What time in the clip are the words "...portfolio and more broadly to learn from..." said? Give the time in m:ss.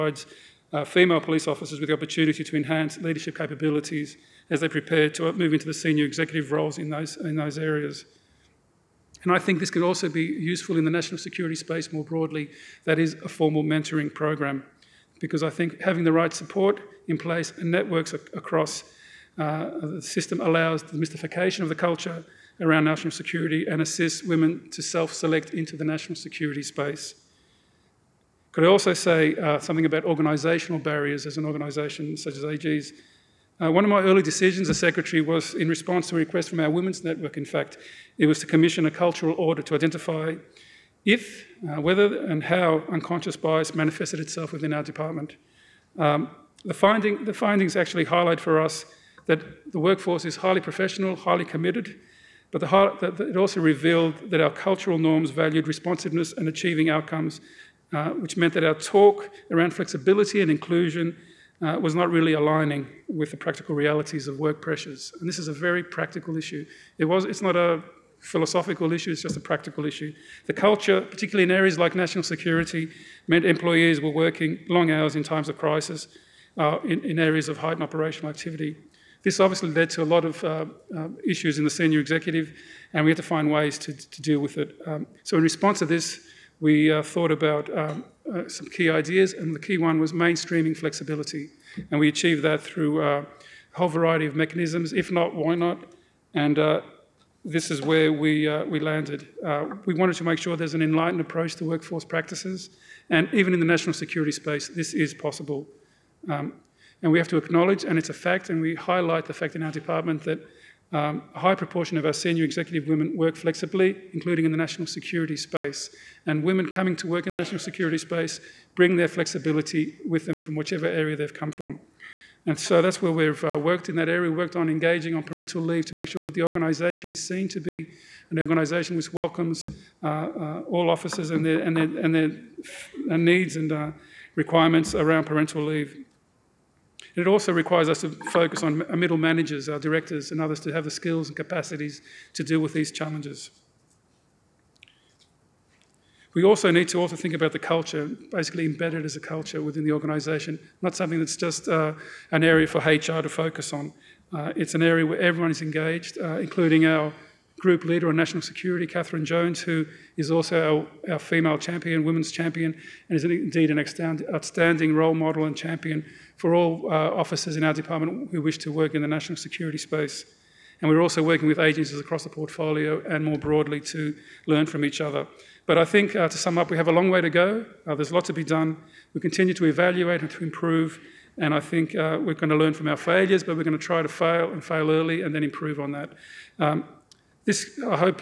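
2:52.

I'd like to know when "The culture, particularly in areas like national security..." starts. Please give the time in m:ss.
1:10.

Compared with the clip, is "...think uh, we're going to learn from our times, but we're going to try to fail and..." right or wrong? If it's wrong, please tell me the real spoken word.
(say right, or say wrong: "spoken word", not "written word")
wrong: "failures", not "times".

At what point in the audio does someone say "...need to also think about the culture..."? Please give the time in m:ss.
2:26.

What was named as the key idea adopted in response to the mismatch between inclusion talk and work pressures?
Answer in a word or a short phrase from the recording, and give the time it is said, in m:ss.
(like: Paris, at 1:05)
mainstreaming flexibility, at 1:30.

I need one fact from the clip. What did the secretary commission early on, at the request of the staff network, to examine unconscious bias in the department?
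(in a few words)
cultural audit.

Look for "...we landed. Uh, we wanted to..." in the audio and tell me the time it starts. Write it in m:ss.
1:38.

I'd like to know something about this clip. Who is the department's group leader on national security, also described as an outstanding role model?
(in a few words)
Catherine Jones.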